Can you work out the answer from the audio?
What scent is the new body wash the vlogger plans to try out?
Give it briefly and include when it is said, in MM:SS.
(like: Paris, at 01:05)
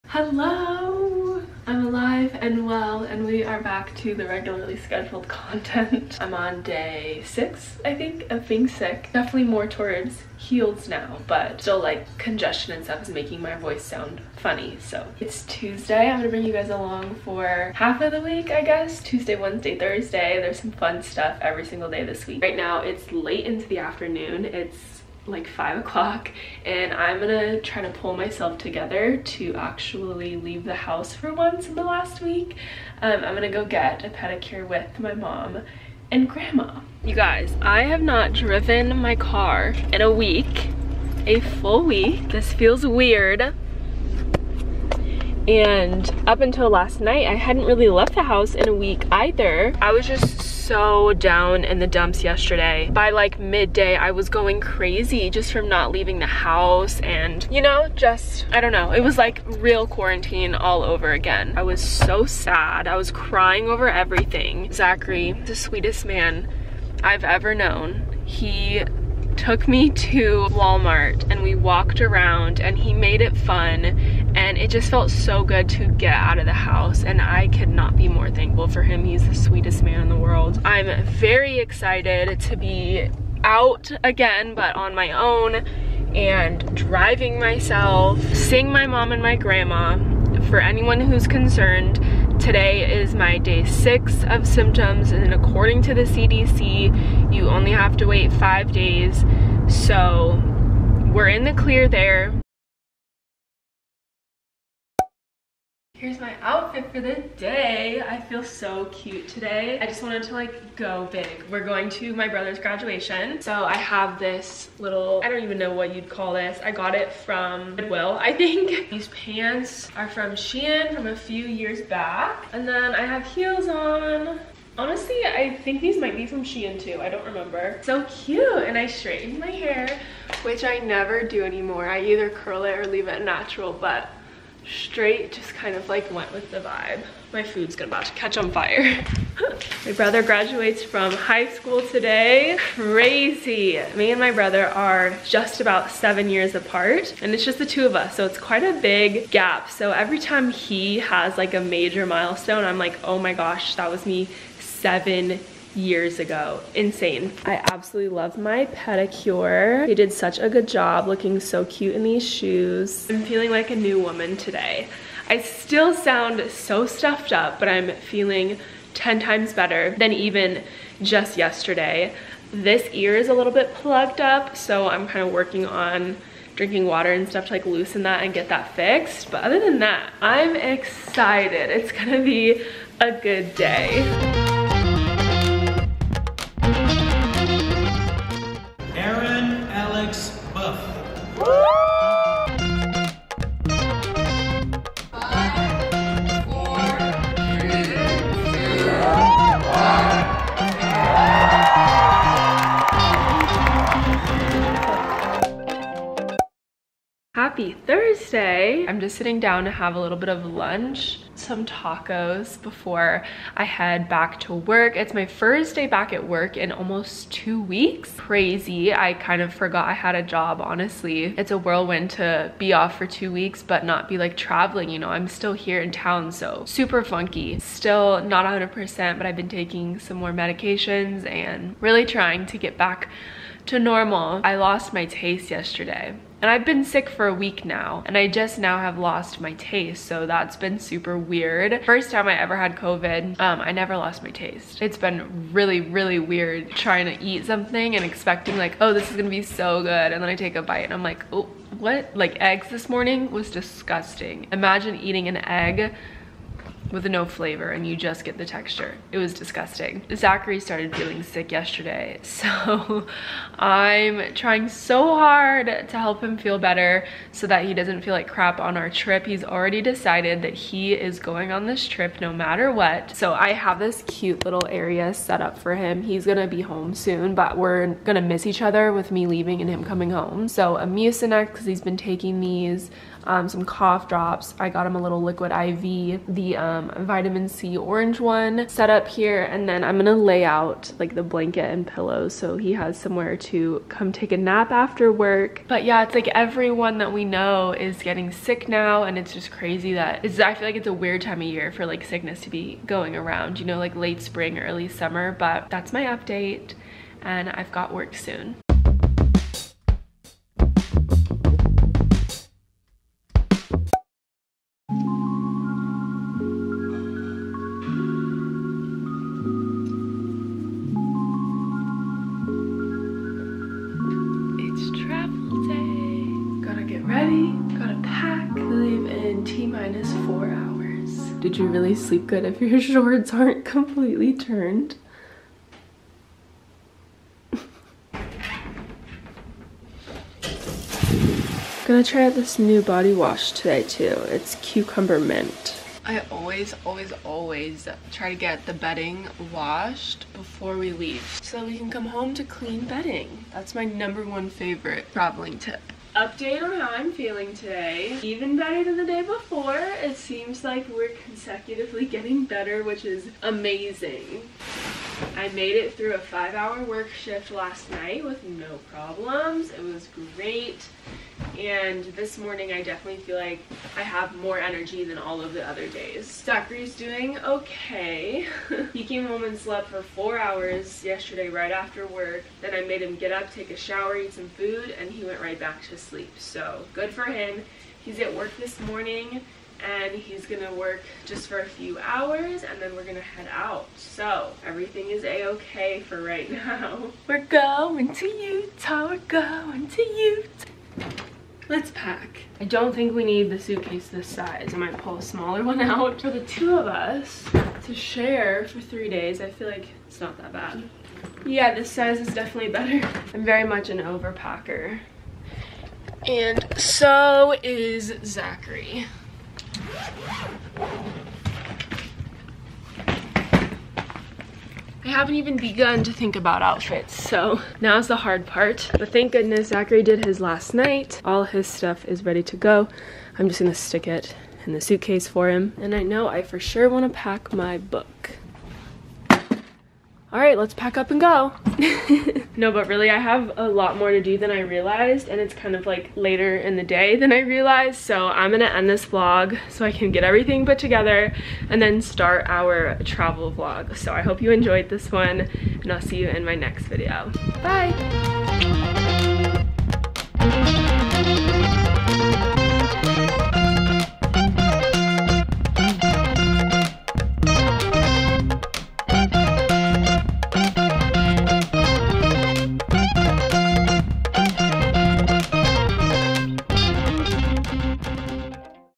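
Cucumber mint, at 05:44.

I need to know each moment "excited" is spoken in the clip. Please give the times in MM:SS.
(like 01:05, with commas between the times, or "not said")
01:21, 03:00.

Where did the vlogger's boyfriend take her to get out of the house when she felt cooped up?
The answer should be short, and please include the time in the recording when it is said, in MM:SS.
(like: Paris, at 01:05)
Walmart, at 01:10.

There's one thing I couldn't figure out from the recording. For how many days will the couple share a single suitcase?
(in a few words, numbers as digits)
3.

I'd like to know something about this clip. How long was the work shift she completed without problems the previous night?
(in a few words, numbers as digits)
5 hours.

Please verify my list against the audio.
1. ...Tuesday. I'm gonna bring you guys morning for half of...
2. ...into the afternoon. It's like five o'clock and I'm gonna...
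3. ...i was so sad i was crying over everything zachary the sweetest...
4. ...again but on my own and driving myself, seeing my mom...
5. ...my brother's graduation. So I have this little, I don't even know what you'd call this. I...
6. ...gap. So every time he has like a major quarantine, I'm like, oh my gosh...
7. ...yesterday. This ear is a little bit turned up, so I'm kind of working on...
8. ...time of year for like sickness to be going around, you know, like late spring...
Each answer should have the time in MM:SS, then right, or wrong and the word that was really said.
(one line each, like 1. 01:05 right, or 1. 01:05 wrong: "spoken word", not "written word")
1. 00:15 wrong: "along", not "morning"
2. 00:23 right
3. 01:01 right
4. 01:24 right
5. 01:52 right
6. 02:29 wrong: "milestone", not "quarantine"
7. 02:51 wrong: "plugged", not "turned"
8. 05:01 right.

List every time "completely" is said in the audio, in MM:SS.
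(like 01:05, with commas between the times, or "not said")
05:33.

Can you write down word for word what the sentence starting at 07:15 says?
And I know I for sure wanna pack my book all right, let's pack up and go.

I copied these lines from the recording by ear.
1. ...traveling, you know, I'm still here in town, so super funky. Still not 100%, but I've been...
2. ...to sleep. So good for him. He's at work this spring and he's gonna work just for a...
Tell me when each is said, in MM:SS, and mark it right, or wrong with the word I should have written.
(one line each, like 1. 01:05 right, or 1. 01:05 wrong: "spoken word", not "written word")
1. 03:44 right
2. 06:25 wrong: "morning", not "spring".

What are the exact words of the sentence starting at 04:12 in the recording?
Like eggs this morning was disgusting.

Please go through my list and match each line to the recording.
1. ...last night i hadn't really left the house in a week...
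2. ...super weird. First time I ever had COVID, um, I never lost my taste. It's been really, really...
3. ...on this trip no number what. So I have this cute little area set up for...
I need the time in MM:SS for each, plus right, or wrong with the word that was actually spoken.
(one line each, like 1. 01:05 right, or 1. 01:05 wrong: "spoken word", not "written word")
1. 00:46 right
2. 04:00 right
3. 04:31 wrong: "matter", not "number".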